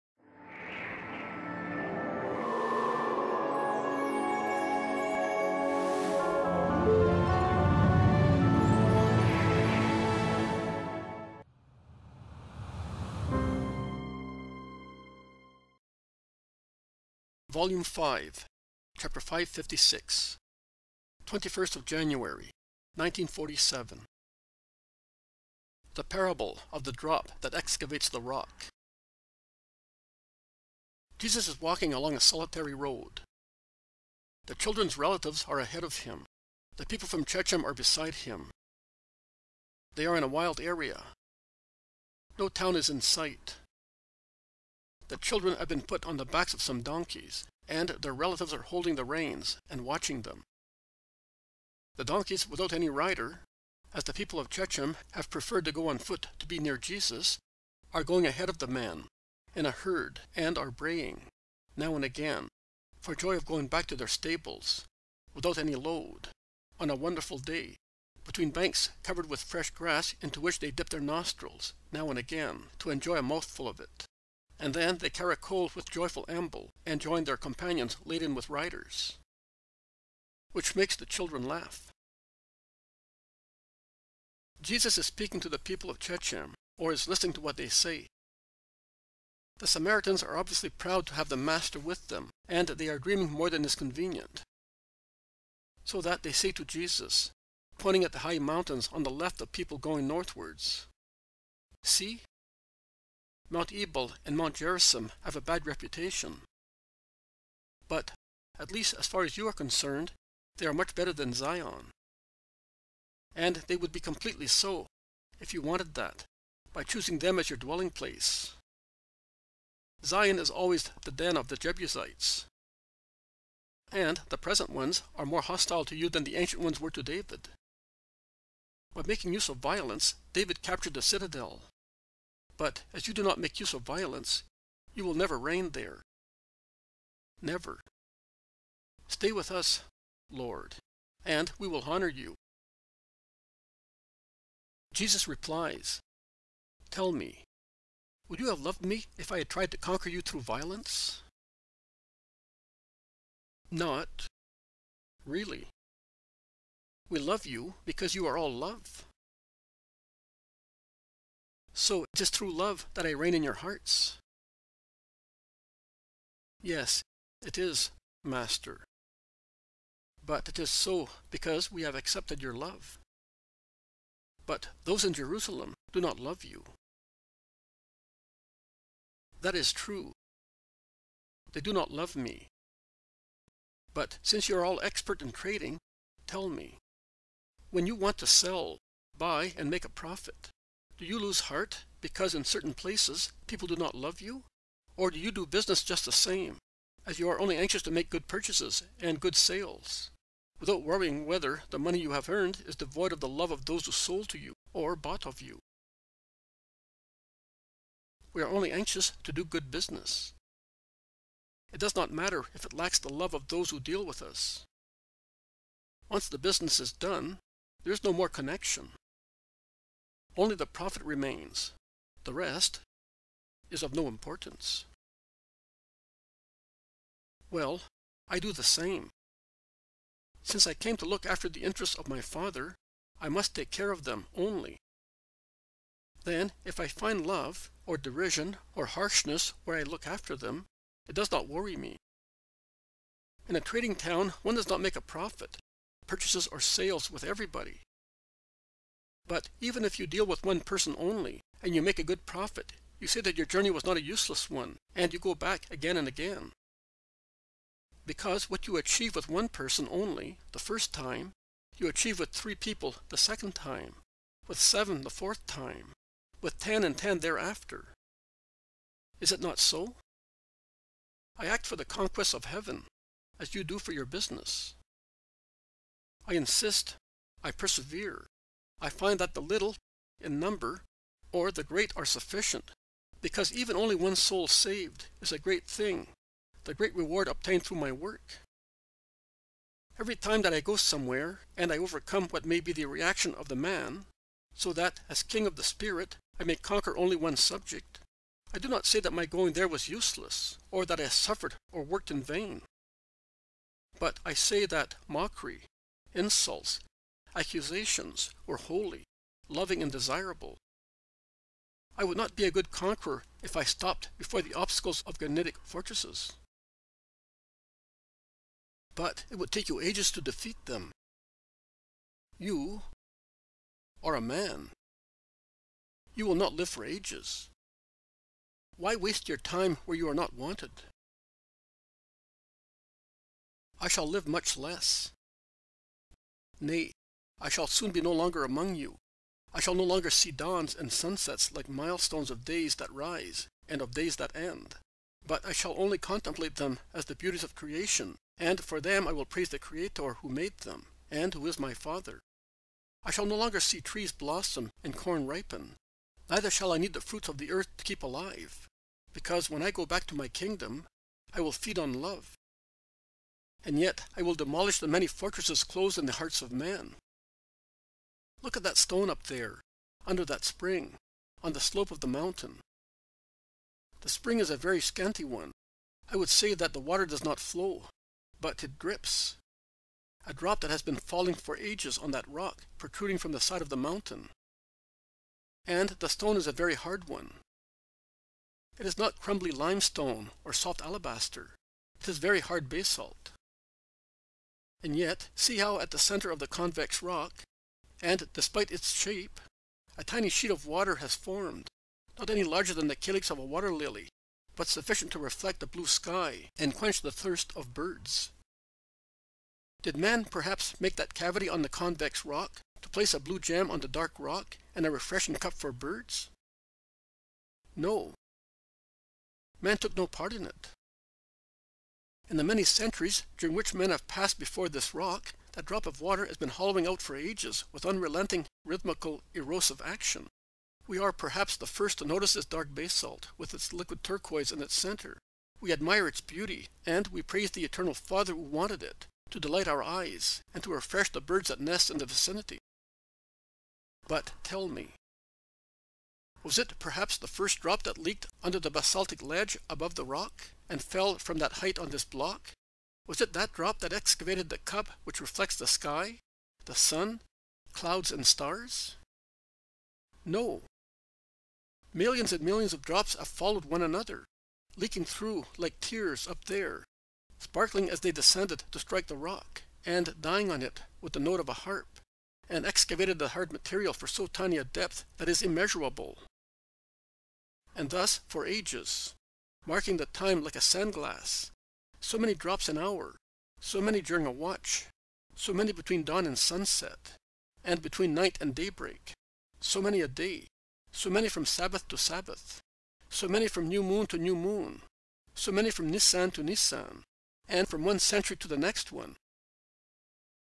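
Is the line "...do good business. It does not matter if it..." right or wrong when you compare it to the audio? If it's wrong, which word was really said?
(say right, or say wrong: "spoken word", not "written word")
right.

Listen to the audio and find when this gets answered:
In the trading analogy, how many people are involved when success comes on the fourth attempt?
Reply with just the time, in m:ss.
4:24.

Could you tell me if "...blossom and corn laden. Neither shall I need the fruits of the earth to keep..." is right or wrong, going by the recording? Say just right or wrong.
wrong.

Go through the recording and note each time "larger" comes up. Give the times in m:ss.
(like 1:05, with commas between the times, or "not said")
6:42.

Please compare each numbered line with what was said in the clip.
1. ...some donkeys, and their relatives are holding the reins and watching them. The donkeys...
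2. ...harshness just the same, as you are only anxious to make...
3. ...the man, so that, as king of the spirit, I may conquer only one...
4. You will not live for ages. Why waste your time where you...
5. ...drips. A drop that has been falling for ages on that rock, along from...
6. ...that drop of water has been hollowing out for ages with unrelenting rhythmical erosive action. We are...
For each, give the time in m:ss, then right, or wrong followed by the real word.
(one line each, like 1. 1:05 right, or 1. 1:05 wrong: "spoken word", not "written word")
1. 0:46 right
2. 3:15 wrong: "business", not "harshness"
3. 4:53 right
4. 5:26 right
5. 6:18 wrong: "protruding", not "along"
6. 7:05 right.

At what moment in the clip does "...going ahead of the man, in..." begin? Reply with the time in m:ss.
0:58.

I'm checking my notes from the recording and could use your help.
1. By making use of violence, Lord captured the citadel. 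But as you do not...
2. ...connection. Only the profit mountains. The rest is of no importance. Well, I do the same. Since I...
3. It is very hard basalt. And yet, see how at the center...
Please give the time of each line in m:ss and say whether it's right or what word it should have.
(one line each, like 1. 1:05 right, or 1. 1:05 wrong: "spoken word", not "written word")
1. 2:08 wrong: "David", not "Lord"
2. 3:38 wrong: "remains", not "mountains"
3. 6:32 right.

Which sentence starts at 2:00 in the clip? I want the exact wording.
Zion is always the den of the Jebusites.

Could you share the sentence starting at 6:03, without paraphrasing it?
And yet I will demolish the many fortresses closed in the hearts of men.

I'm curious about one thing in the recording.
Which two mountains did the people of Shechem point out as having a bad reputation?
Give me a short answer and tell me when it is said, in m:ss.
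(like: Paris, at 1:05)
Mount Ebal and Mount Gerizim, at 1:43.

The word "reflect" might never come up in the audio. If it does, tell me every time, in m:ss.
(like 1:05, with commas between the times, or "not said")
6:45, 7:35.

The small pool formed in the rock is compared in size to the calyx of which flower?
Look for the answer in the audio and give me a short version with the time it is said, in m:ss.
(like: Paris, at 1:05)
Water lily, at 6:43.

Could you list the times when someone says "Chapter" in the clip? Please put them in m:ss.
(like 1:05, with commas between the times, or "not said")
0:18.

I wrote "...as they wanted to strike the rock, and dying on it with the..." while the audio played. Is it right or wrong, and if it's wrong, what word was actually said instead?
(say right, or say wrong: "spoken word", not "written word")
wrong: "descended", not "wanted".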